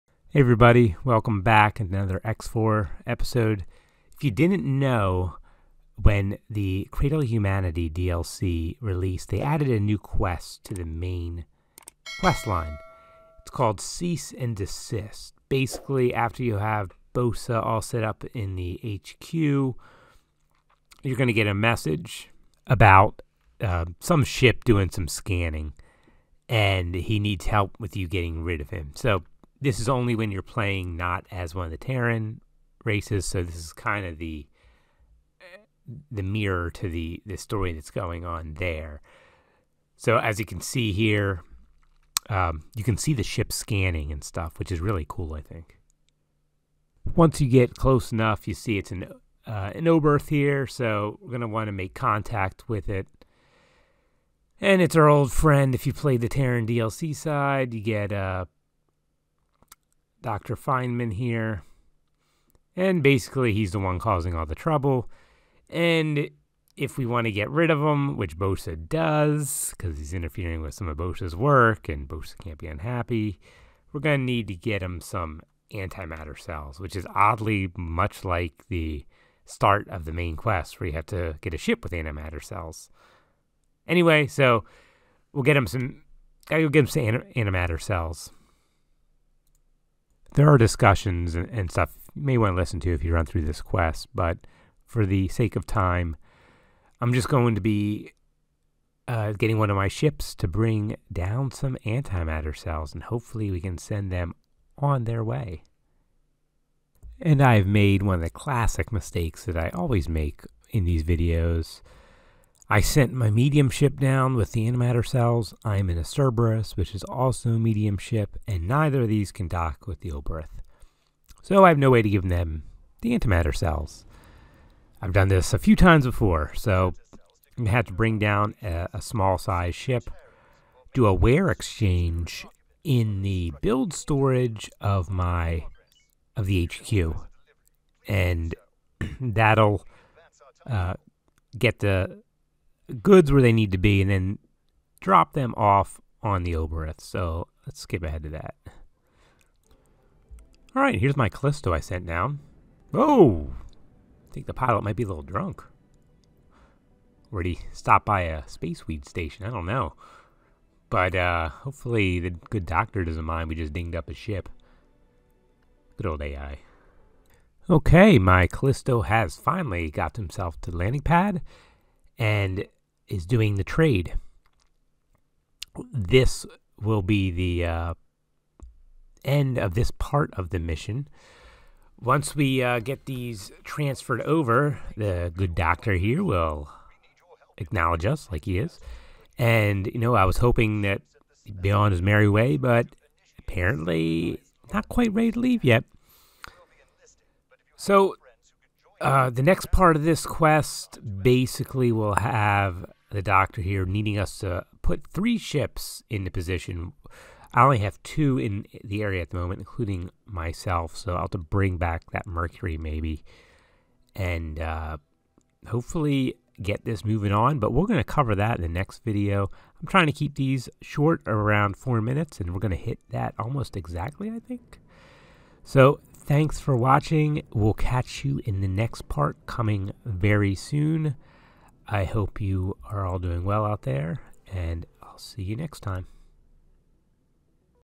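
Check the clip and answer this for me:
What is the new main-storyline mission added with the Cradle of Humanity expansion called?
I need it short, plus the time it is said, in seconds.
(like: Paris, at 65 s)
Cease and Desist, at 13 s.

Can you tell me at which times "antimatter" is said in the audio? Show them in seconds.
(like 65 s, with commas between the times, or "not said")
75 s, 81 s, 87 s, 101 s, 114 s, 123 s.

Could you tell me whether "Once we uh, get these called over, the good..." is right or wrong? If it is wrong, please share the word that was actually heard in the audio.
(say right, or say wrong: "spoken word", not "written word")
wrong: "transferred", not "called".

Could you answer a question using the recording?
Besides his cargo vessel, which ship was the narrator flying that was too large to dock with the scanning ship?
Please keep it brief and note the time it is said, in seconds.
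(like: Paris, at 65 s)
Cerberus, at 116 s.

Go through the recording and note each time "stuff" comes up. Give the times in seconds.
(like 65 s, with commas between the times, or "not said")
44 s, 91 s.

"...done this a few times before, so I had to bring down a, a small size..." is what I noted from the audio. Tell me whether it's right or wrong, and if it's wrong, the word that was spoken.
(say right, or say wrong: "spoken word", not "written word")
right.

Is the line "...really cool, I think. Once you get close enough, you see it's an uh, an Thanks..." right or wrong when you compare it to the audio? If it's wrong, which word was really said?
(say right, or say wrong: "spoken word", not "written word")
wrong: "Oberth", not "Thanks".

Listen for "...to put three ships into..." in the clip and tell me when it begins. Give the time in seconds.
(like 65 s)
204 s.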